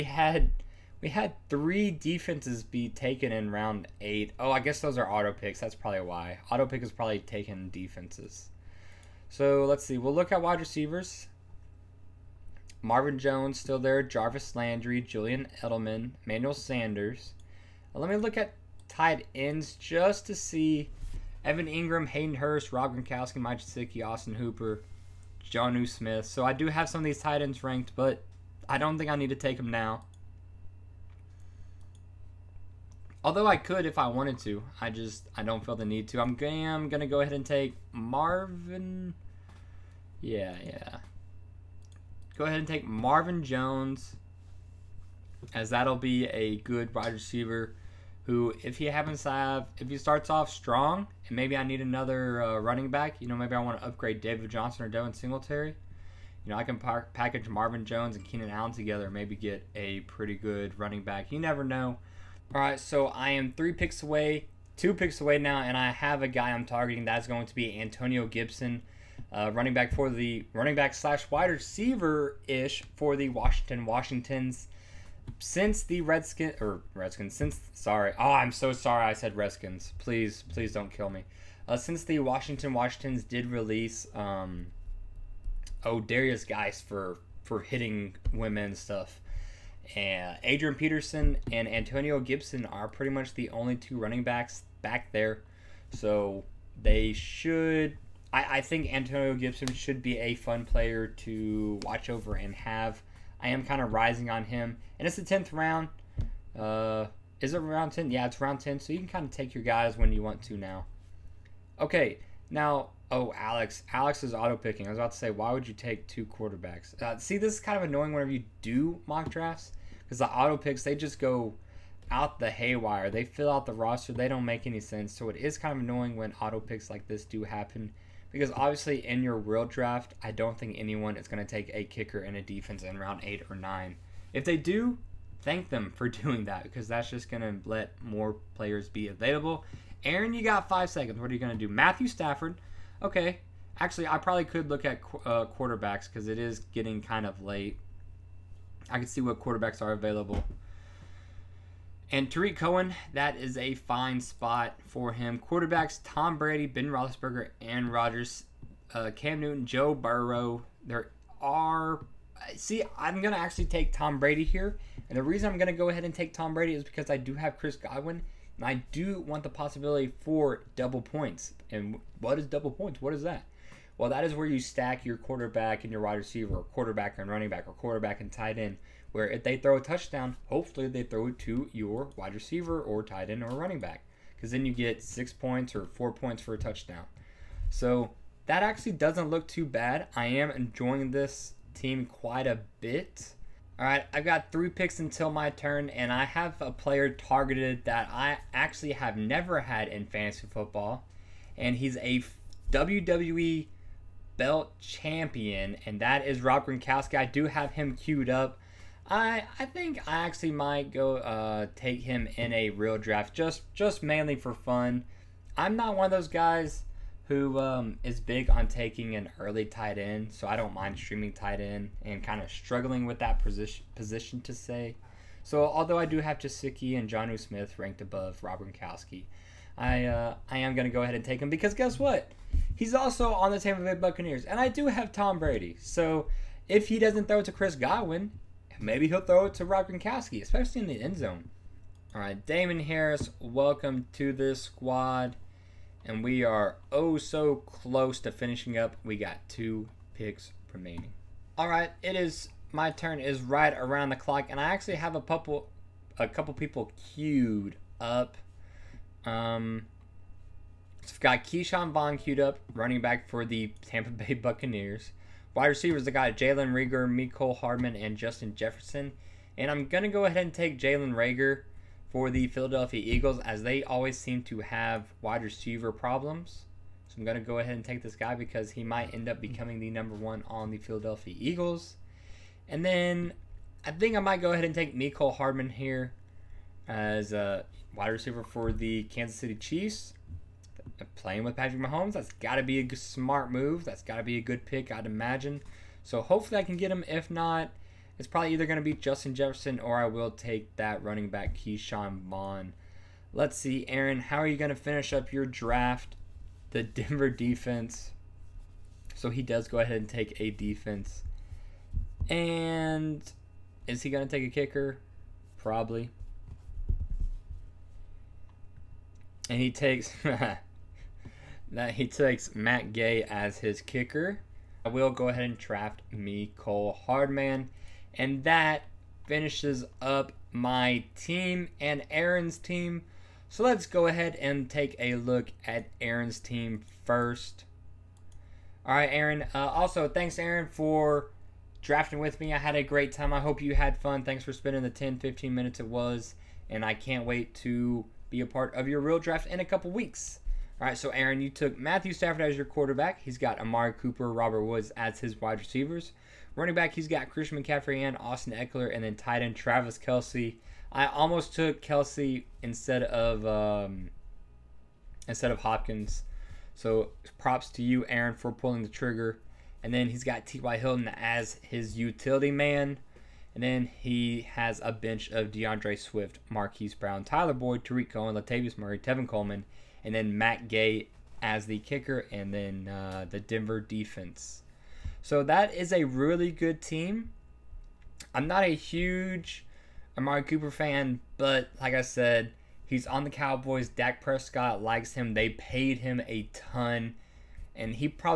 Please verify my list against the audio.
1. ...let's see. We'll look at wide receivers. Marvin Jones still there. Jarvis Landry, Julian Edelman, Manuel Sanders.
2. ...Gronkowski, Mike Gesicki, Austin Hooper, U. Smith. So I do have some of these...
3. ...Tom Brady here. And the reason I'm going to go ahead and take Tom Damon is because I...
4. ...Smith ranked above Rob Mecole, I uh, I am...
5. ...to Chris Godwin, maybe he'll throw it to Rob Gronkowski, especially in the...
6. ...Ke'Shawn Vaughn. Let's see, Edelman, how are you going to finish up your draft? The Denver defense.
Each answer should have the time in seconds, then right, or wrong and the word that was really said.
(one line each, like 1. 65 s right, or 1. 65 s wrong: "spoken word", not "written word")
1. 9 s right
2. 22 s right
3. 163 s wrong: "Brady", not "Damon"
4. 227 s wrong: "Gronkowski", not "Mecole"
5. 237 s right
6. 301 s wrong: "Aaron", not "Edelman".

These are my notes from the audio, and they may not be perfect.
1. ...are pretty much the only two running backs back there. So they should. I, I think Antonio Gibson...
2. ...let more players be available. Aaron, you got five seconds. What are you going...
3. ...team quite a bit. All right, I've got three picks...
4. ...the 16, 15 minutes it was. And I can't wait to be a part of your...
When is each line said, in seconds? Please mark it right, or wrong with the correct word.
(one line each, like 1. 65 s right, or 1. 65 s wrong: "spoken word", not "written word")
1. 92 s right
2. 137 s right
3. 191 s right
4. 344 s wrong: "10", not "16".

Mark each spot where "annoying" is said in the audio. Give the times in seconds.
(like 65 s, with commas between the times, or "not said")
117 s, 125 s.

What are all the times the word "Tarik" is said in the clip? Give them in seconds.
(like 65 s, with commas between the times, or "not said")
152 s, 377 s.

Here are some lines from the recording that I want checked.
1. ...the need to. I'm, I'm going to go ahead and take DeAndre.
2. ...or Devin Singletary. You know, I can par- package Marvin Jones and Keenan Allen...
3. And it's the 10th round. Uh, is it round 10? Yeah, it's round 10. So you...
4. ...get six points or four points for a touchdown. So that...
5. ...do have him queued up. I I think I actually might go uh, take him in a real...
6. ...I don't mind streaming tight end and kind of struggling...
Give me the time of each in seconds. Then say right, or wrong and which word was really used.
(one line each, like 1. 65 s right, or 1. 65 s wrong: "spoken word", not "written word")
1. 35 s wrong: "Marvin", not "DeAndre"
2. 54 s right
3. 104 s right
4. 184 s right
5. 207 s right
6. 220 s right.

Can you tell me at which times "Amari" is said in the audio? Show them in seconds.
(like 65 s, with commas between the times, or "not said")
353 s, 390 s.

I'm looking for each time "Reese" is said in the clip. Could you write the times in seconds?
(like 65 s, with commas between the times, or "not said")
not said.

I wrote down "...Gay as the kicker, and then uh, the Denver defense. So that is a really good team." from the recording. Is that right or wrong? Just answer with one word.
right.